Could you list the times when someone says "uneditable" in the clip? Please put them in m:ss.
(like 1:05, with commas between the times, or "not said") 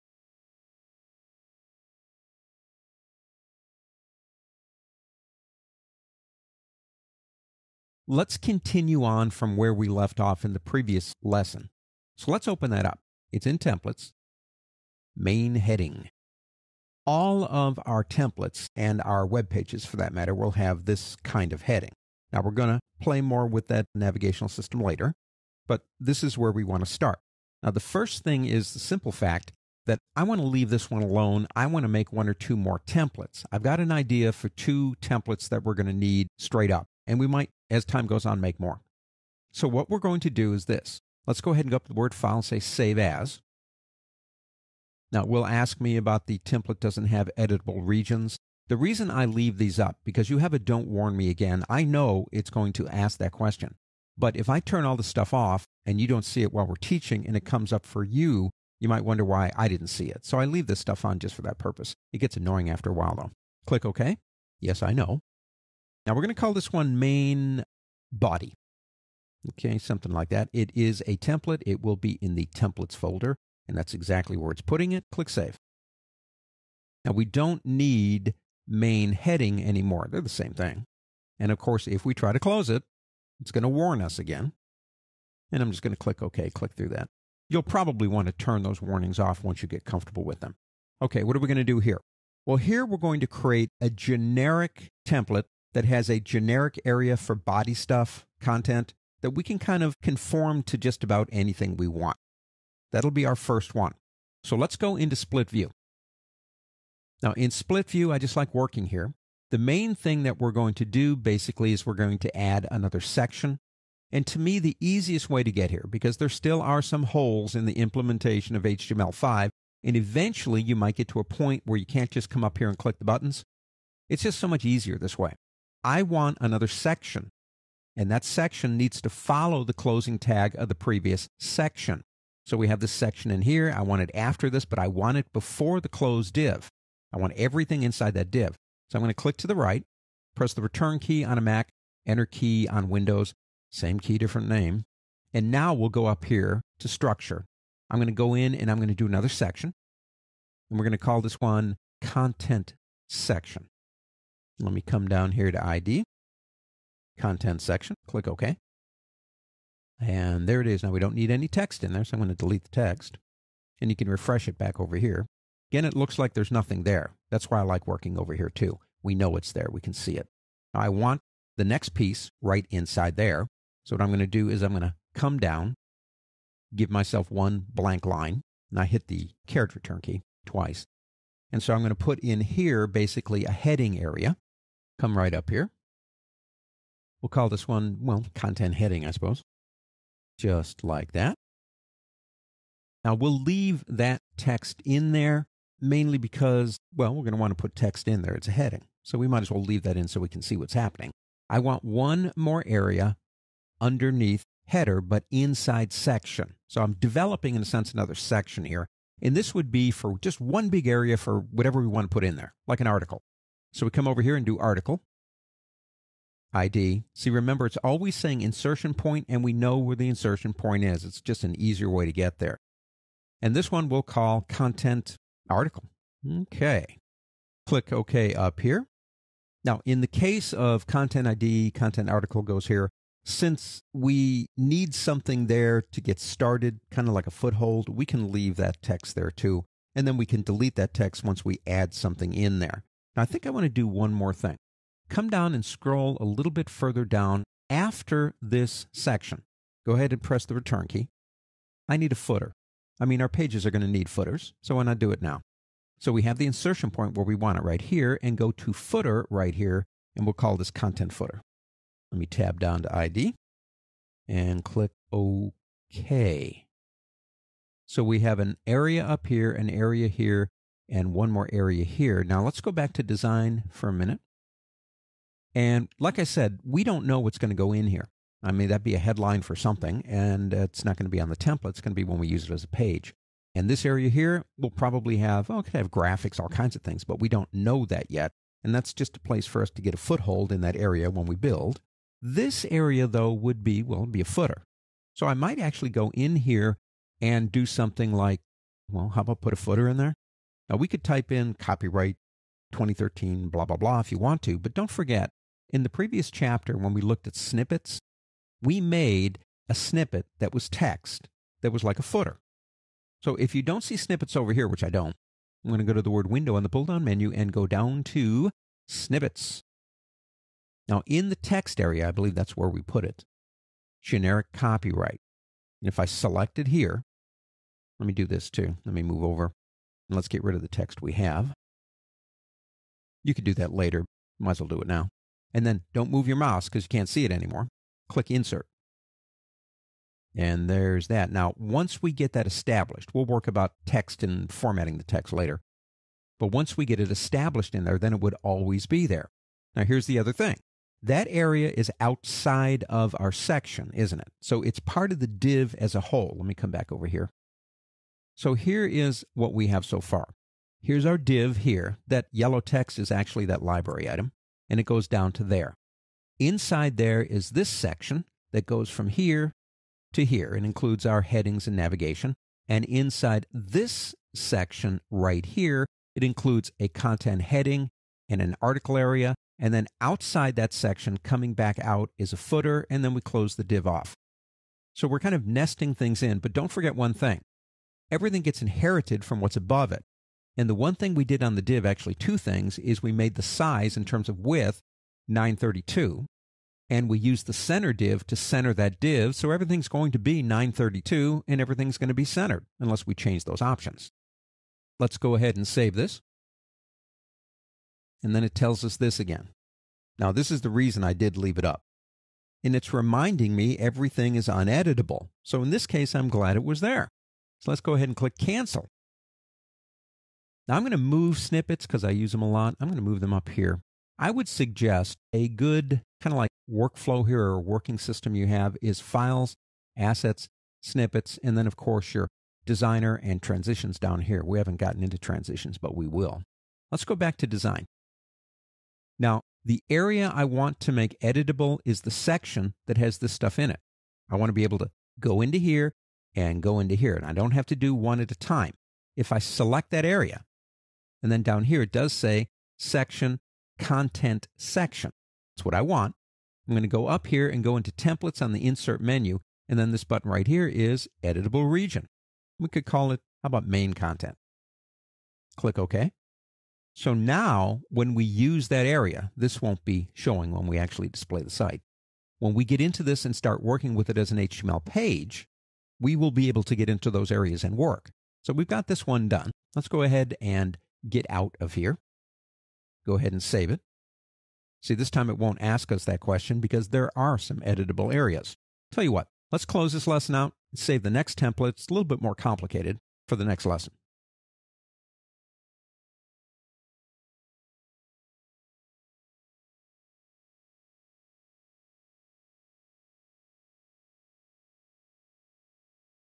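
6:54.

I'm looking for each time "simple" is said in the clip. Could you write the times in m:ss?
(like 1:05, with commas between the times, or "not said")
0:28.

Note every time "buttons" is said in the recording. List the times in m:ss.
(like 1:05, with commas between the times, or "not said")
2:03, 7:40.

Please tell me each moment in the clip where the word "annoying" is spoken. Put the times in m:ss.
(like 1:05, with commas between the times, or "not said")
1:02.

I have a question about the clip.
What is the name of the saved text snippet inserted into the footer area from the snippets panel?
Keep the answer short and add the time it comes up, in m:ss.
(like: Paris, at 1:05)
generic copyright, at 5:24.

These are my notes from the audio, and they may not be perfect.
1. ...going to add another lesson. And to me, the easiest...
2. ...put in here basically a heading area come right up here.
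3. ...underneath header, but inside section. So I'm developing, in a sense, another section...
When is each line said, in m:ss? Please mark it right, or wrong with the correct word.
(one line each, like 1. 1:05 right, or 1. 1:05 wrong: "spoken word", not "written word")
1. 1:51 wrong: "section", not "lesson"
2. 3:01 right
3. 3:23 right.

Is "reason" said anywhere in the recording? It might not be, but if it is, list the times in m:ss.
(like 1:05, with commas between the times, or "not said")
0:48, 6:50.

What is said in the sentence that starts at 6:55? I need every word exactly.
So in this case, I'm glad it was there.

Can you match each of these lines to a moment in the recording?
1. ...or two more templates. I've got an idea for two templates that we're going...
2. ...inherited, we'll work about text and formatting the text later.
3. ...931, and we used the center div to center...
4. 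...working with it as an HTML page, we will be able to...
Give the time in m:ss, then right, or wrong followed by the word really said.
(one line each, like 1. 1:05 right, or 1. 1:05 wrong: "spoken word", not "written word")
1. 0:32 right
2. 5:42 wrong: "established", not "inherited"
3. 6:35 wrong: "932", not "931"
4. 7:53 right.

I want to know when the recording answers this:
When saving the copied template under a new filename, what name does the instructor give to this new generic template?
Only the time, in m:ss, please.
1:06.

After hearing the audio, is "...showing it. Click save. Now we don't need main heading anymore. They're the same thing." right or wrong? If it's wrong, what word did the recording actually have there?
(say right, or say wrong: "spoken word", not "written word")
wrong: "putting", not "showing".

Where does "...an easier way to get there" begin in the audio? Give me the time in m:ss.
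3:41.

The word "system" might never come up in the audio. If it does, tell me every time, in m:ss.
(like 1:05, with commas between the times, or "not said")
0:24, 7:07.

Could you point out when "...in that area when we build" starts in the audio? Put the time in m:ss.
4:50.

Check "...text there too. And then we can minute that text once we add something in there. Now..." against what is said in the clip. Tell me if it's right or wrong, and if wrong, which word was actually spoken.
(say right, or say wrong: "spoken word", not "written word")
wrong: "delete", not "minute".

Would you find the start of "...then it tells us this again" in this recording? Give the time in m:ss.
6:48.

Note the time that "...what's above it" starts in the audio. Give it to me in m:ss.
6:29.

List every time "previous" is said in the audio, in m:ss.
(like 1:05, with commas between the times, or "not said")
0:10, 2:10, 5:05.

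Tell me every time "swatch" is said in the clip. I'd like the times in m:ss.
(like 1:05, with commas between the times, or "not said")
not said.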